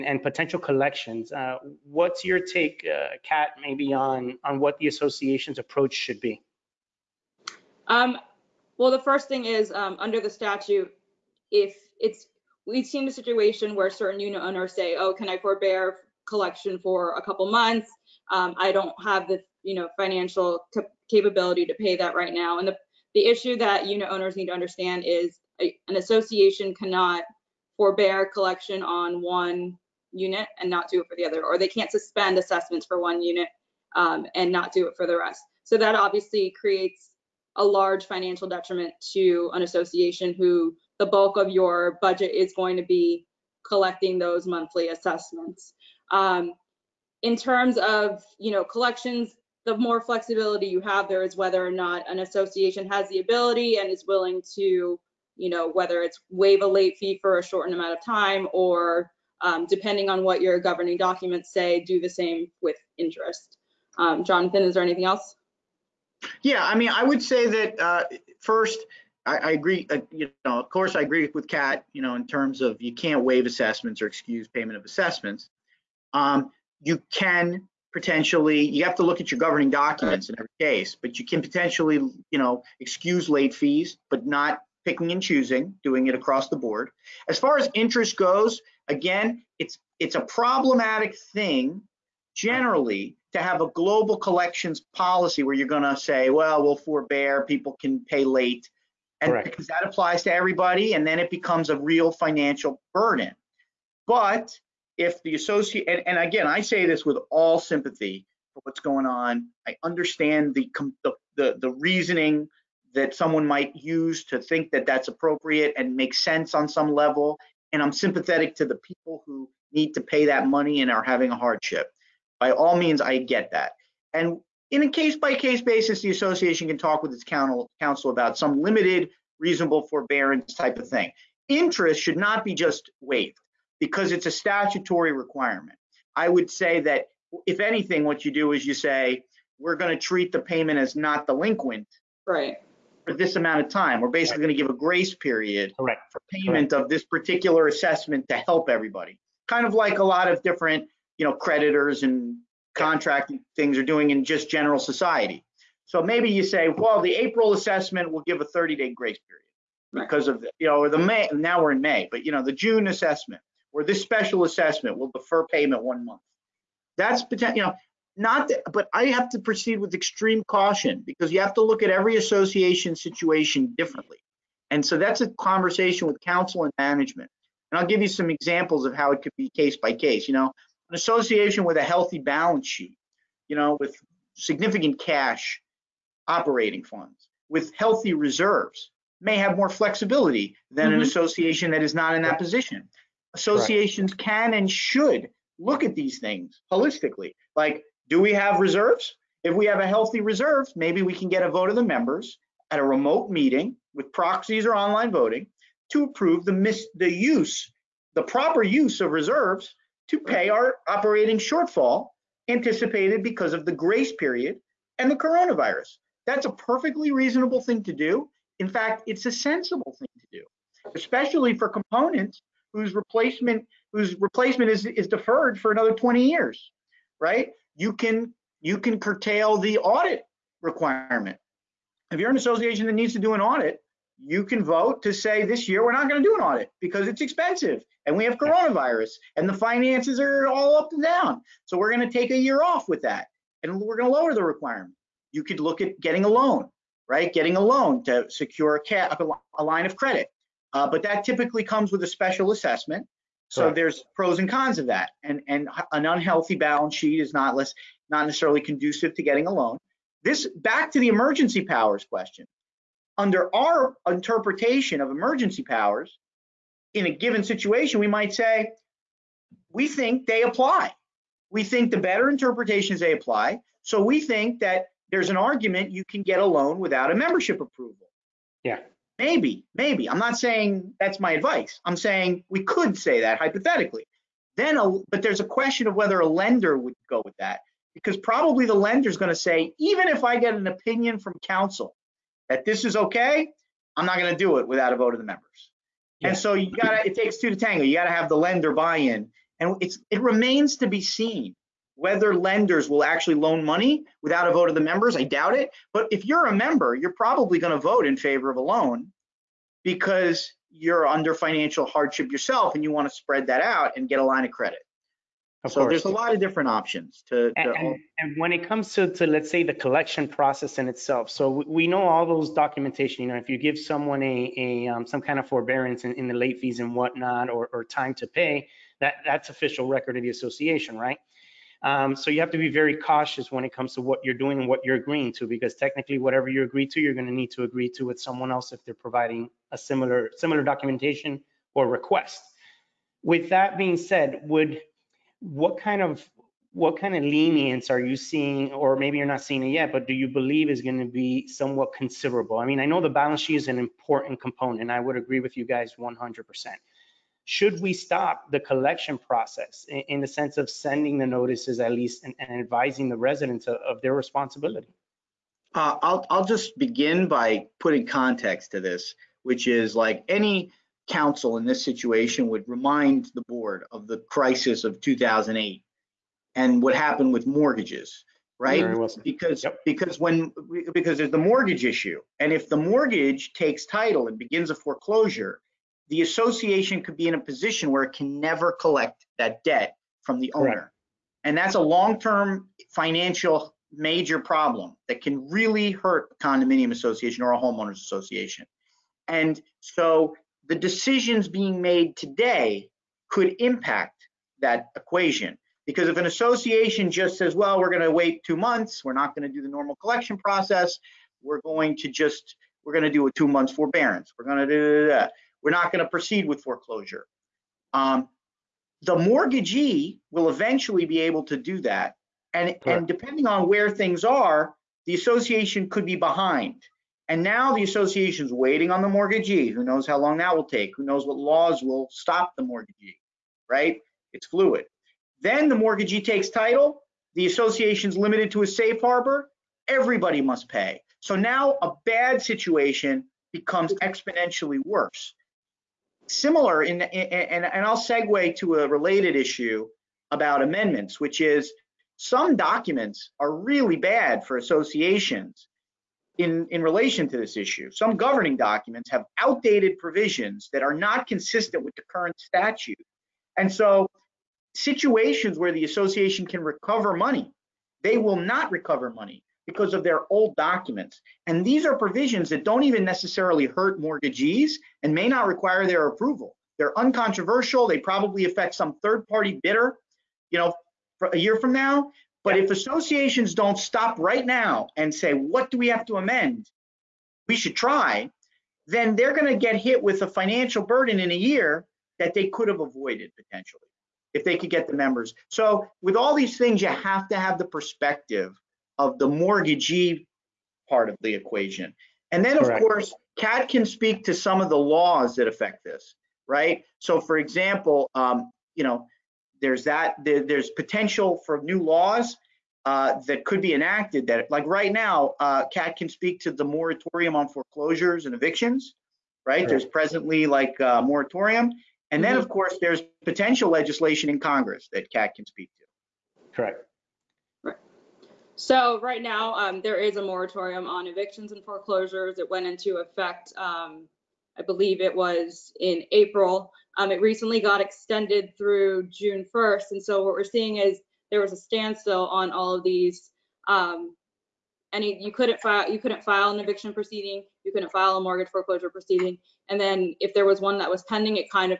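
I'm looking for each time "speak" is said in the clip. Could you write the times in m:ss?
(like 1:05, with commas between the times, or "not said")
8:23, 8:36, 8:45.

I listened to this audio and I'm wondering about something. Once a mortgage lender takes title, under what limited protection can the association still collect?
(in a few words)
safe harbor.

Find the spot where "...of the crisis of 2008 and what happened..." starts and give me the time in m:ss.
6:13.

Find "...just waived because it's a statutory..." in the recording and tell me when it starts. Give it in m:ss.
2:12.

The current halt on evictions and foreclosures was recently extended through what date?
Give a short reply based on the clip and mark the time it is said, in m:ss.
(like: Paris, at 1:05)
June 1st, at 8:59.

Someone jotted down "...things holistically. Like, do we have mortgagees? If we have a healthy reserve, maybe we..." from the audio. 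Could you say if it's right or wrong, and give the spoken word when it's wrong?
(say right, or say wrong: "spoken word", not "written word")
wrong: "reserves", not "mortgagees".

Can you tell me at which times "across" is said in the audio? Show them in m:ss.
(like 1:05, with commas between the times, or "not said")
1:26.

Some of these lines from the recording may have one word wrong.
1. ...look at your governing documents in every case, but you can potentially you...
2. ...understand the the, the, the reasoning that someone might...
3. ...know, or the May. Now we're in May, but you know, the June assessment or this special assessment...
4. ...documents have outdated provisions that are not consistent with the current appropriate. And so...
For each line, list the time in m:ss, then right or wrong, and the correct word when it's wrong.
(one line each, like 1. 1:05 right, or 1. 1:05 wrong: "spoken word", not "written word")
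1. 1:19 right
2. 1:49 right
3. 2:40 right
4. 7:38 wrong: "statute", not "appropriate".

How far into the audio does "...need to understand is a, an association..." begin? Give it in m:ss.
0:24.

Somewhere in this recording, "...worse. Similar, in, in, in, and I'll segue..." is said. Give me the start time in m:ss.
7:24.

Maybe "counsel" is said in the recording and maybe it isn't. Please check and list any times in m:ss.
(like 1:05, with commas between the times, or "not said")
2:07, 2:56, 4:51, 6:11.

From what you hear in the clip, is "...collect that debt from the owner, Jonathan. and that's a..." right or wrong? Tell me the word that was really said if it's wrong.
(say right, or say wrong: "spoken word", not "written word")
wrong: "Correct", not "Jonathan".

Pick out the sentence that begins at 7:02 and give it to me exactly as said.
And, and depending on where things are, the association could be behind and now the association's waiting on the mortgagee.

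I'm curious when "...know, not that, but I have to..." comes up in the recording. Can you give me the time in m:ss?
2:47.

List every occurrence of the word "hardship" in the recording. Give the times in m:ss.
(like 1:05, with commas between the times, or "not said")
2:01, 5:11.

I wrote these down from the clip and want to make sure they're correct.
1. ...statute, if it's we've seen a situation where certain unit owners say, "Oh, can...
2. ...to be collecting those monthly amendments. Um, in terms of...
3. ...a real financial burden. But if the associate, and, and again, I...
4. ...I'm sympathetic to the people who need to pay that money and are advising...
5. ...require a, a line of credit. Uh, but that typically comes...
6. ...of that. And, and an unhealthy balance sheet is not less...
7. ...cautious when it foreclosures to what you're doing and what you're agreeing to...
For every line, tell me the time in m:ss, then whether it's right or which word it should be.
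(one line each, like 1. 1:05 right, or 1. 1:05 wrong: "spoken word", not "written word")
1. 0:10 right
2. 0:42 wrong: "assessments", not "amendments"
3. 1:41 right
4. 1:57 wrong: "having", not "advising"
5. 4:08 wrong: "secure", not "require"
6. 4:14 right
7. 5:32 wrong: "comes", not "foreclosures".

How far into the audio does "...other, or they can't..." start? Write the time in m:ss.
0:31.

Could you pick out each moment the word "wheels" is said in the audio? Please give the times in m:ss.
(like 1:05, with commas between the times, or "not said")
not said.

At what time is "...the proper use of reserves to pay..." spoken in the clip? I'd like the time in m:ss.
3:28.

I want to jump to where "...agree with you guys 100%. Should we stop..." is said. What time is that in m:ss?
5:55.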